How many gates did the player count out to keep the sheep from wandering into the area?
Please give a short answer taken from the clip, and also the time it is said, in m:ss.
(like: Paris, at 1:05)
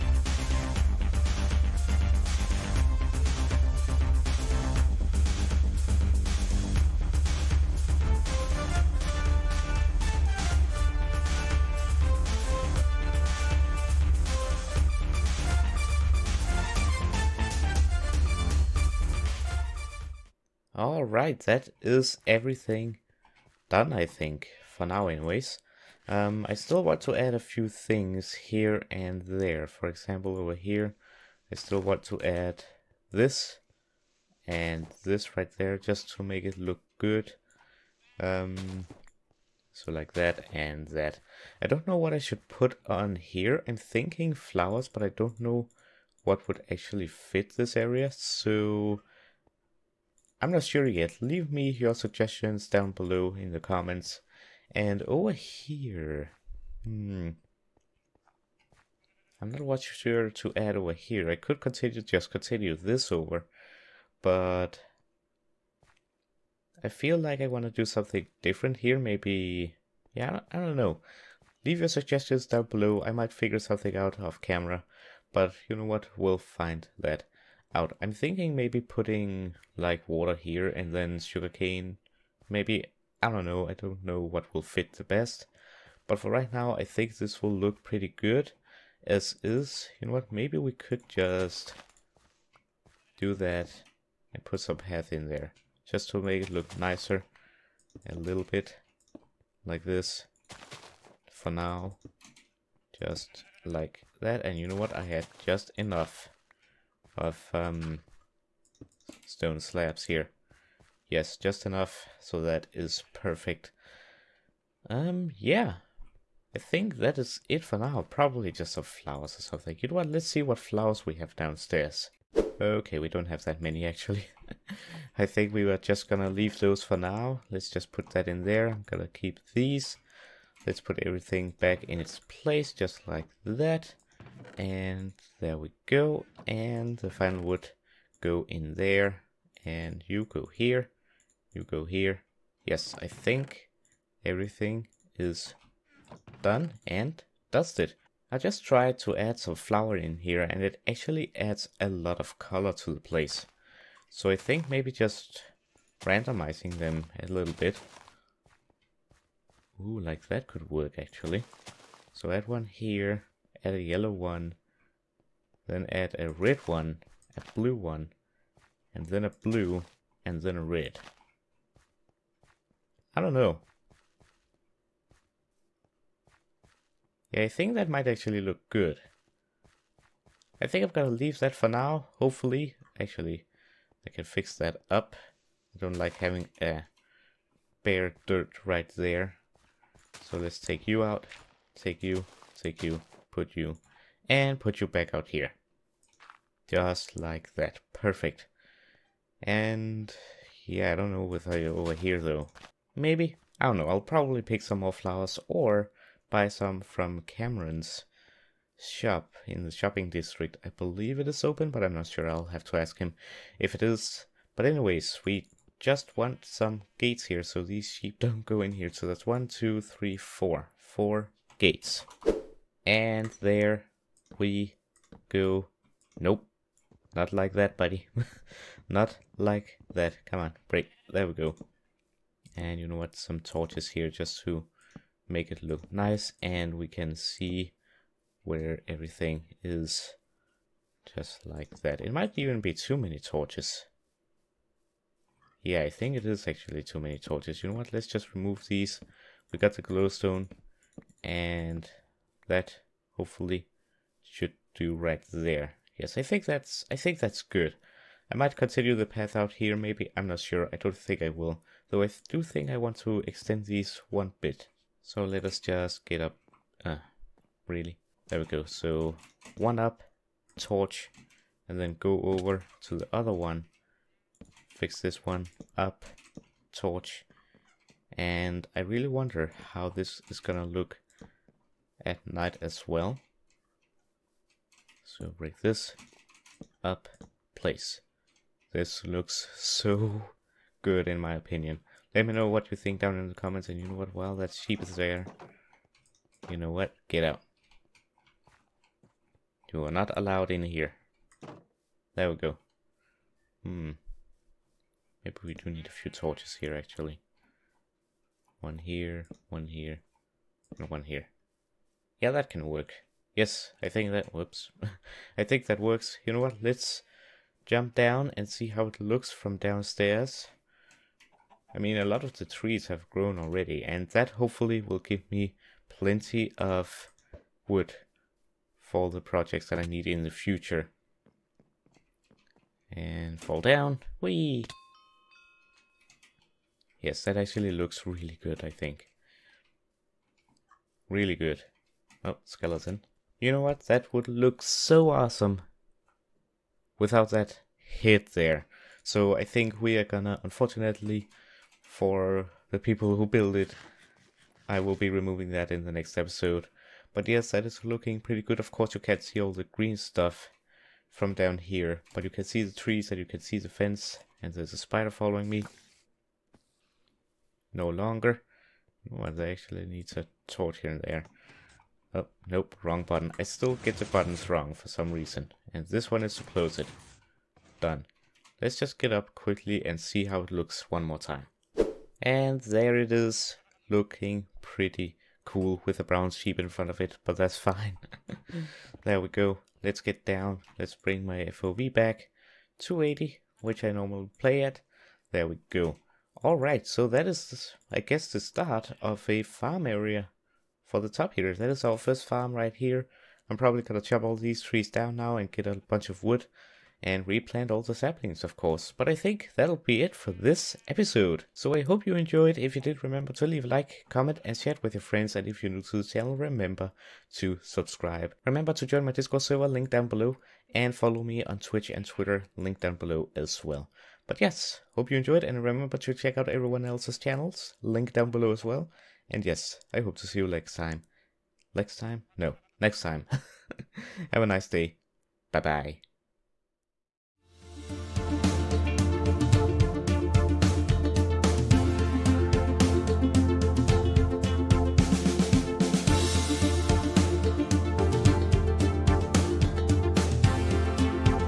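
4, at 3:40.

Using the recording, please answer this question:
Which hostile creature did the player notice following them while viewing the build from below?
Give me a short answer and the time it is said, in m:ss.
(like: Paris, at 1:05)
A spider, at 6:04.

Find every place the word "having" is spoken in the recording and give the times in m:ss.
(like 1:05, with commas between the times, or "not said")
3:06.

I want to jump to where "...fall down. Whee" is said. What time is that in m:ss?
5:33.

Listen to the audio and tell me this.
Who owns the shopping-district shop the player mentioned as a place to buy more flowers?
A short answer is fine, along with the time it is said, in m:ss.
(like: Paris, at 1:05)
Kameron, at 3:27.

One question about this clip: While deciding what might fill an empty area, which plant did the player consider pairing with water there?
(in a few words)
Sugarcane.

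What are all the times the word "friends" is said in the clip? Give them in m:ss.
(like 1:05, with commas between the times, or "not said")
6:55.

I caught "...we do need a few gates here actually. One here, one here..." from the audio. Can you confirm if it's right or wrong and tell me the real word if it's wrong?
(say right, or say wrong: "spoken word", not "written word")
wrong: "torches", not "gates".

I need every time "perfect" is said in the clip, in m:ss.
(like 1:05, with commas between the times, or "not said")
1:53, 3:17.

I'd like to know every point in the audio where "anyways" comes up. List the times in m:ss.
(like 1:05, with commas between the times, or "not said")
0:25, 3:34.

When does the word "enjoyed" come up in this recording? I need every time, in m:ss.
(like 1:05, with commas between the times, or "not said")
6:52, 7:05.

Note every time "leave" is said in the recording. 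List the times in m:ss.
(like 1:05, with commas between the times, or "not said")
0:51, 1:11, 2:06, 3:01, 6:53.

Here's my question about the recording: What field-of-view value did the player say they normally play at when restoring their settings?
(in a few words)
280.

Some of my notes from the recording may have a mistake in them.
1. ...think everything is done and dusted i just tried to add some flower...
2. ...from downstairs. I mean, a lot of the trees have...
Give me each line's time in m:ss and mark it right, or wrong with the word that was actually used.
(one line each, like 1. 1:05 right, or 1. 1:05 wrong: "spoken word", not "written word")
1. 2:23 right
2. 5:19 right.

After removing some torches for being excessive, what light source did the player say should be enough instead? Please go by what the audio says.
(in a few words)
Glowstone.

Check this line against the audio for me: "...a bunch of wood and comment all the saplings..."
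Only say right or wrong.
wrong.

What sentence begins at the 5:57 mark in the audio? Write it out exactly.
But yes, that is looking pretty good.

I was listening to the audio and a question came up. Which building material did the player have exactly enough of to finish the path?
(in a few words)
Stone slabs.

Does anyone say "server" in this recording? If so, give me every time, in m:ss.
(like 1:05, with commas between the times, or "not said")
6:59.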